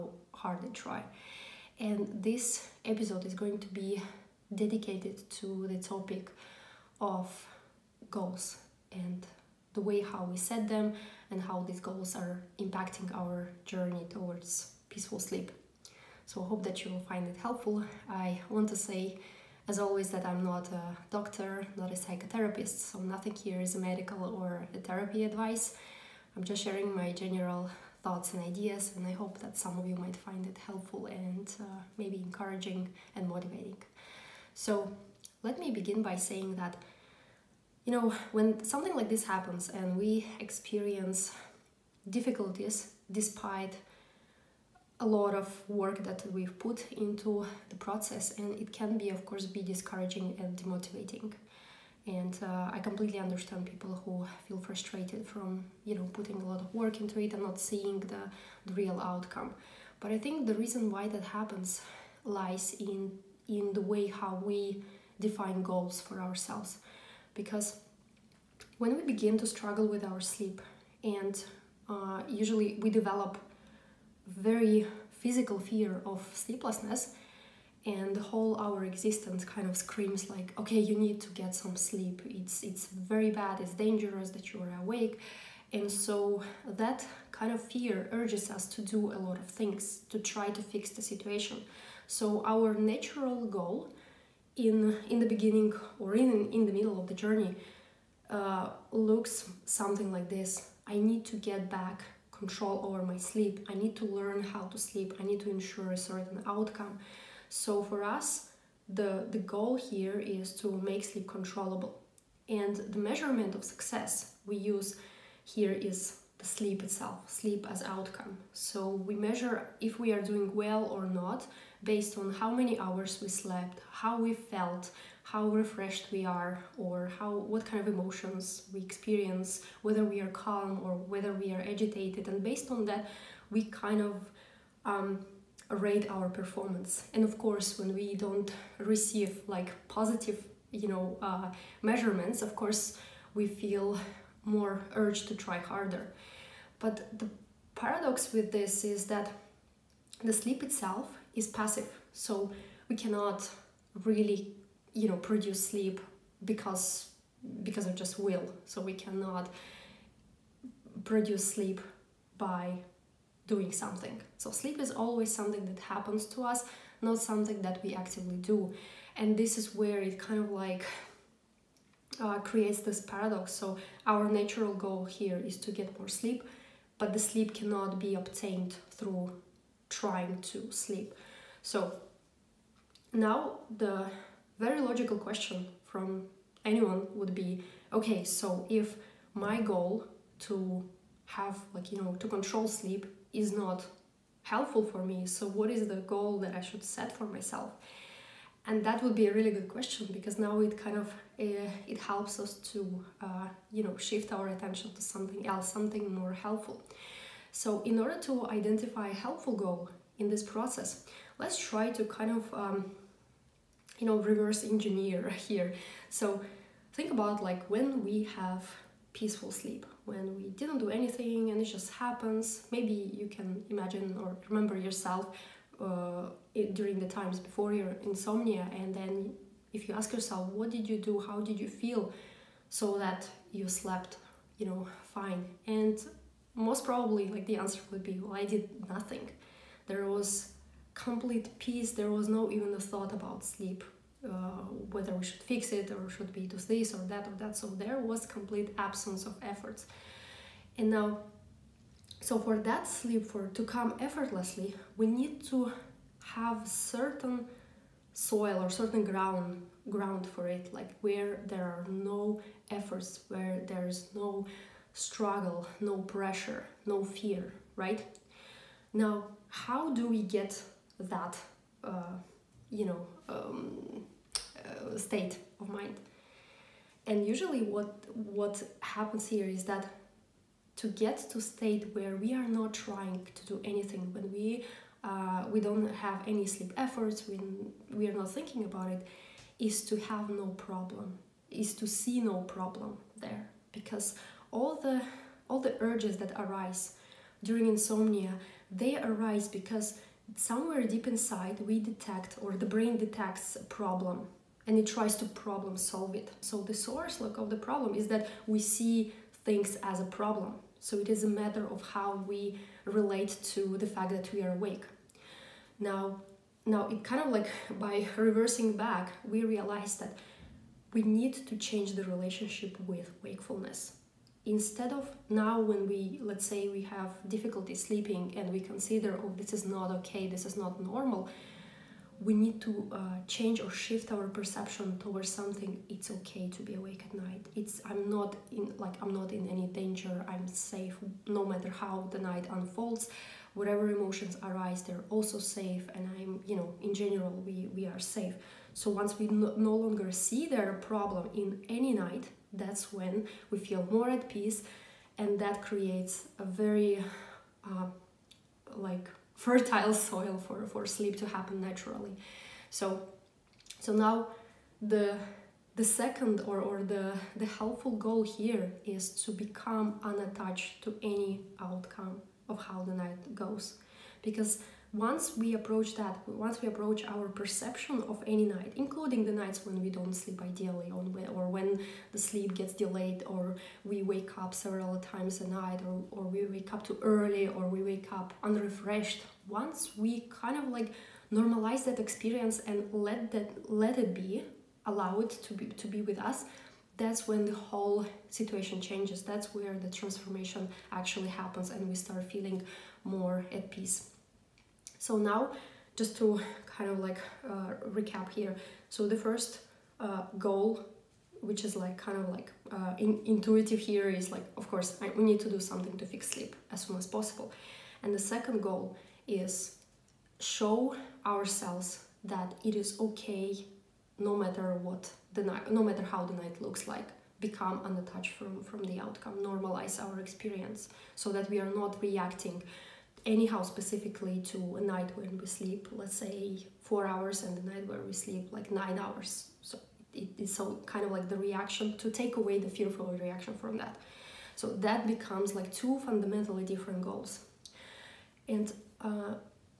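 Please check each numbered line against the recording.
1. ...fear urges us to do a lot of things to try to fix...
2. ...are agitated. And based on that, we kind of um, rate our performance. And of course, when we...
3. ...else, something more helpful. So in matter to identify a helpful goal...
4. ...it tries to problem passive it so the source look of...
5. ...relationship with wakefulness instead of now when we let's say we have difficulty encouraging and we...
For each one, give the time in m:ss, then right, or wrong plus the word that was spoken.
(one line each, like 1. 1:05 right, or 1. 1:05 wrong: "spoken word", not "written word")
1. 1:27 right
2. 2:11 right
3. 3:25 wrong: "order", not "matter"
4. 5:04 wrong: "solve", not "passive"
5. 5:22 wrong: "sleeping", not "encouraging".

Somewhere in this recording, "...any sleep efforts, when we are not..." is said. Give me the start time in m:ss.
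4:46.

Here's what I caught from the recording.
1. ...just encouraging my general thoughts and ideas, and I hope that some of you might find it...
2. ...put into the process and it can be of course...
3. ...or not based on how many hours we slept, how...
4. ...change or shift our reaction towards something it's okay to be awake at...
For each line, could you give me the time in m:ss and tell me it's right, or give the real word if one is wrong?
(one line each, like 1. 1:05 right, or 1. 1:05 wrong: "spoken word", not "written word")
1. 0:26 wrong: "sharing", not "encouraging"
2. 0:46 right
3. 2:00 right
4. 5:33 wrong: "perception", not "reaction".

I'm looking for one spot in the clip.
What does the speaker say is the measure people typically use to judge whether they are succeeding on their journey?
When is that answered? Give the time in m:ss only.
1:57.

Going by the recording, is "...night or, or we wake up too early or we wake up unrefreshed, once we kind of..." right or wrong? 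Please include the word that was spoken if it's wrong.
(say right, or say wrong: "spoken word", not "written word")
right.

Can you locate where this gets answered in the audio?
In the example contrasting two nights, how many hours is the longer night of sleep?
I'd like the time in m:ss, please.
7:18.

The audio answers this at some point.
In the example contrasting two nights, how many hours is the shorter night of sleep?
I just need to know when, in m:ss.
7:16.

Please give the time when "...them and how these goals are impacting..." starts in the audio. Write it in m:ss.
0:10.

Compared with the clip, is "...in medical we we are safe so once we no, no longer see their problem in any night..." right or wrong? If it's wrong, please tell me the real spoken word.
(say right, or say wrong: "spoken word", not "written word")
wrong: "general", not "medical".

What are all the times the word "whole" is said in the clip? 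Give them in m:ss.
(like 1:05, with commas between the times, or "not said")
1:18, 6:37.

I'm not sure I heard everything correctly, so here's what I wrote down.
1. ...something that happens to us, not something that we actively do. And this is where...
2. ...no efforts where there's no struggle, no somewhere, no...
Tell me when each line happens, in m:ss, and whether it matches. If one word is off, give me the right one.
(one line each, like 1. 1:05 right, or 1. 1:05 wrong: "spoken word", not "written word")
1. 2:45 right
2. 4:21 wrong: "pressure", not "somewhere".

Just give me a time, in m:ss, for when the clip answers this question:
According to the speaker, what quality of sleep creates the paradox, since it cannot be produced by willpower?
2:31.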